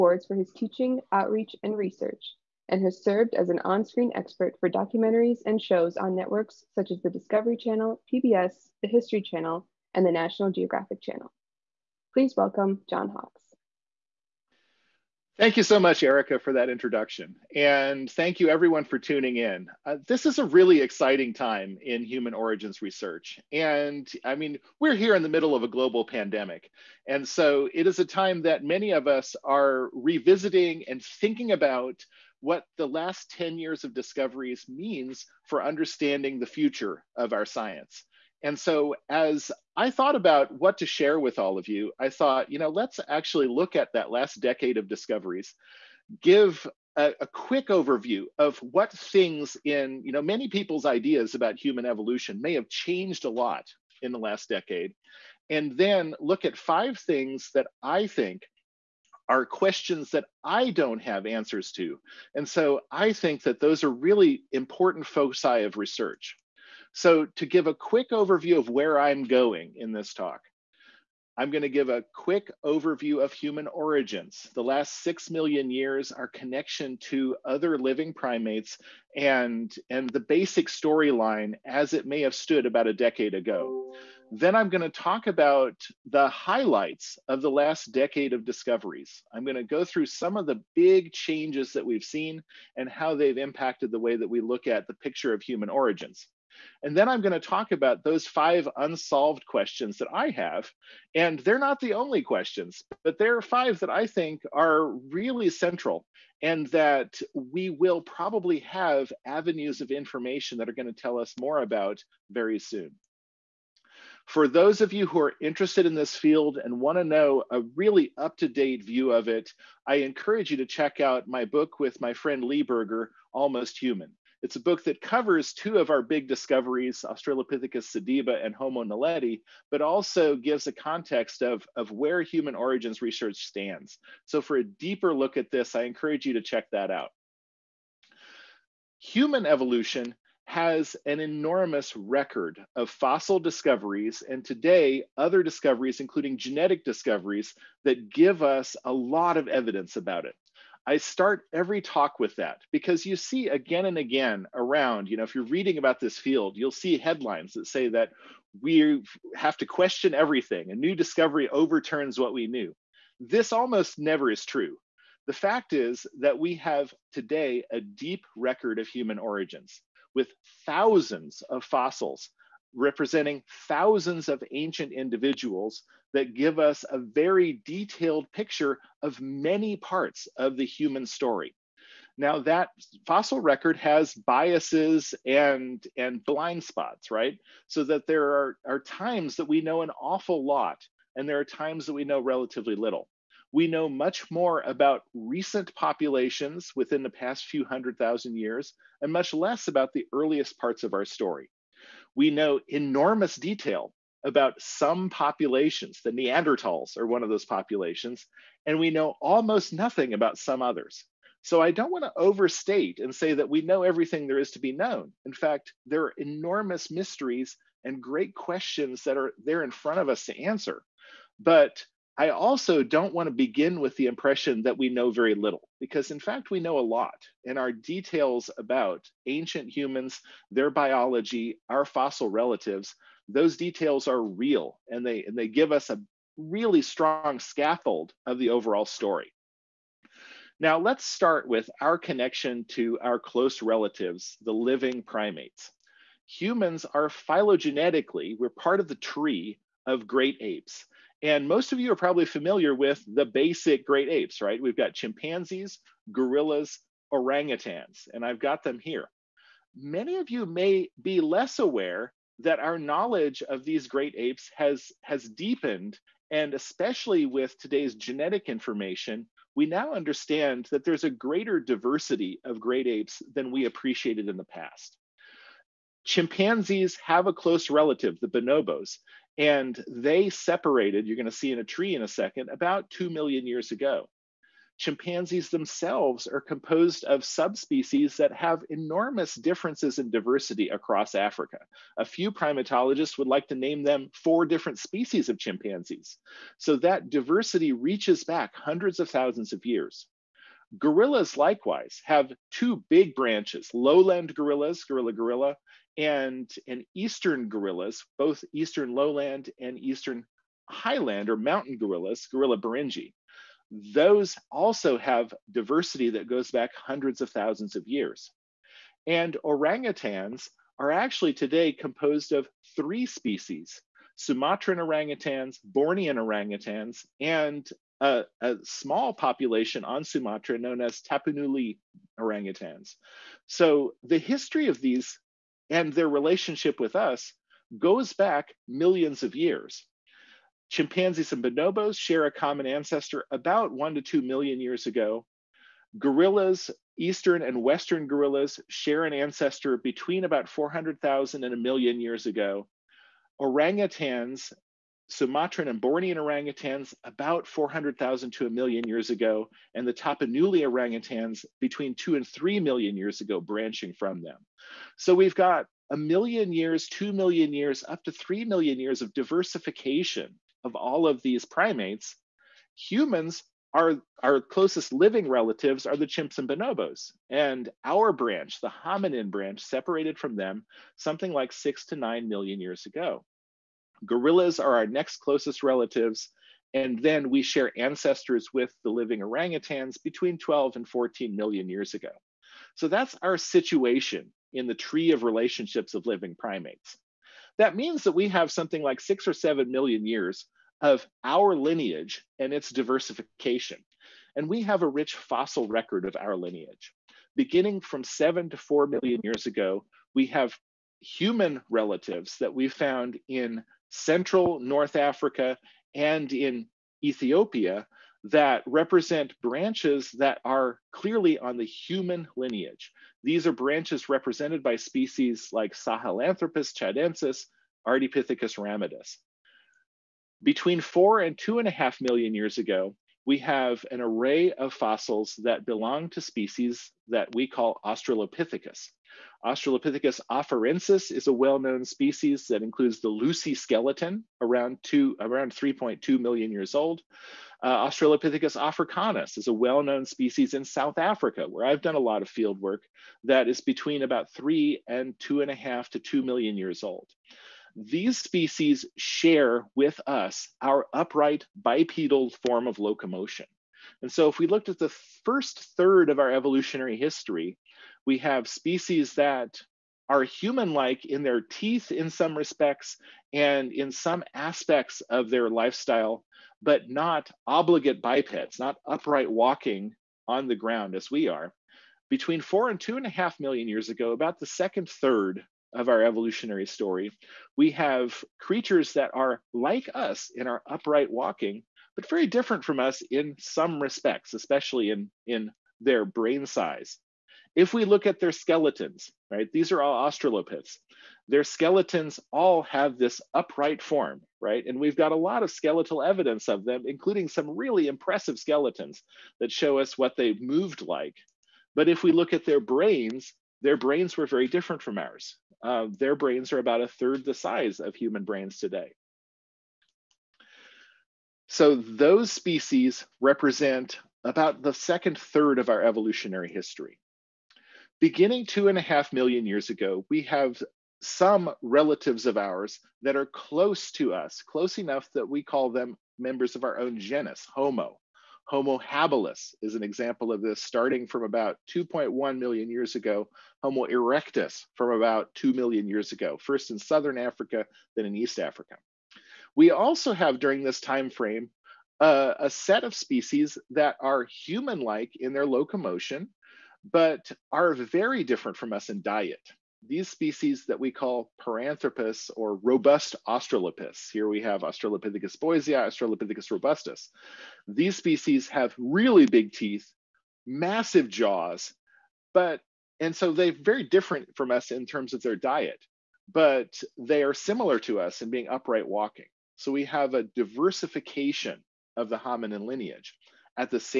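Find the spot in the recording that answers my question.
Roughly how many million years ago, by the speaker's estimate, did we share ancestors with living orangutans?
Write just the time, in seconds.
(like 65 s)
390 s.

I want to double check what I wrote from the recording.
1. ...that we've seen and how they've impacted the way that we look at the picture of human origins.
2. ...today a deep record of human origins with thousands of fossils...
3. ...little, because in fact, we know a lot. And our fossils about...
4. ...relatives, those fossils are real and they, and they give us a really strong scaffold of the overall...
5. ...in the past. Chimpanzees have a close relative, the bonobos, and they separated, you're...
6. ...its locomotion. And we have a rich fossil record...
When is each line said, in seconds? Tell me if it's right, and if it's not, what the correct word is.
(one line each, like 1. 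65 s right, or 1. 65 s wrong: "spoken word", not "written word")
1. 91 s right
2. 167 s right
3. 225 s wrong: "details", not "fossils"
4. 232 s wrong: "details", not "fossils"
5. 274 s right
6. 402 s wrong: "diversification", not "locomotion".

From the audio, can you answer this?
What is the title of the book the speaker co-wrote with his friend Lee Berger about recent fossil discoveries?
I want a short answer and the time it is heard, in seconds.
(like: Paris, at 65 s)
Almost Human, at 123 s.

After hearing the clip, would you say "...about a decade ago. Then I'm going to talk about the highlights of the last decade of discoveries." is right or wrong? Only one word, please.
right.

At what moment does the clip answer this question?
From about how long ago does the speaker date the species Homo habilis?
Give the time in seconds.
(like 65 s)
541 s.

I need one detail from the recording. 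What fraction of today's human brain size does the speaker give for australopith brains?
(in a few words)
About a third.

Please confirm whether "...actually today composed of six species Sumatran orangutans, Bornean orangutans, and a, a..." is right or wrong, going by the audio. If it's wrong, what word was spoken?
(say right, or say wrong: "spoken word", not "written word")
wrong: "three", not "six".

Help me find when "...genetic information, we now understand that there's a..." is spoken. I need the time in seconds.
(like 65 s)
267 s.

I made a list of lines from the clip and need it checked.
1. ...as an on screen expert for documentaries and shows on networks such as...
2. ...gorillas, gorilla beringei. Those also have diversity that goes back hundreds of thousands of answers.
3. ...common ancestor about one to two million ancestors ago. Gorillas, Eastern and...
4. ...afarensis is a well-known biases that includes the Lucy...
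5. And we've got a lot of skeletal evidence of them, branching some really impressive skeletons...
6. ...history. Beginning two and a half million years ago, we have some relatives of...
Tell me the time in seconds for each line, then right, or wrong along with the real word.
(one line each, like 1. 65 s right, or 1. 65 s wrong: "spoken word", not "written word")
1. 3 s right
2. 311 s wrong: "years", not "answers"
3. 342 s wrong: "years", not "ancestors"
4. 440 s wrong: "species", not "biases"
5. 504 s wrong: "including", not "branching"
6. 526 s right.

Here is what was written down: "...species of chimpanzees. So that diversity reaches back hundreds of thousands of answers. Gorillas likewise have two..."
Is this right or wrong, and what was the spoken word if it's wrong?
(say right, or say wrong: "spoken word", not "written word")
wrong: "years", not "answers".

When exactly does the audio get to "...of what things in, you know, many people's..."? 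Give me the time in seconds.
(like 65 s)
48 s.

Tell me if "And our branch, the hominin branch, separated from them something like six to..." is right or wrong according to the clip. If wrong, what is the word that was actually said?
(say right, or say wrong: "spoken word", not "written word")
right.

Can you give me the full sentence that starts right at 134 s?
So for a deeper look at this, I encourage you to check that out.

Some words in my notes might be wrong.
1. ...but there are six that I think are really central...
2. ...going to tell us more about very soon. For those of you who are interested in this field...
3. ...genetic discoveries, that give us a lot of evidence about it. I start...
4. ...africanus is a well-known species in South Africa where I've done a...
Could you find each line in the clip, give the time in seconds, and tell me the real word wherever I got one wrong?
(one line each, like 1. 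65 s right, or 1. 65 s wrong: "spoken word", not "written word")
1. 103 s wrong: "five", not "six"
2. 110 s right
3. 146 s right
4. 448 s right.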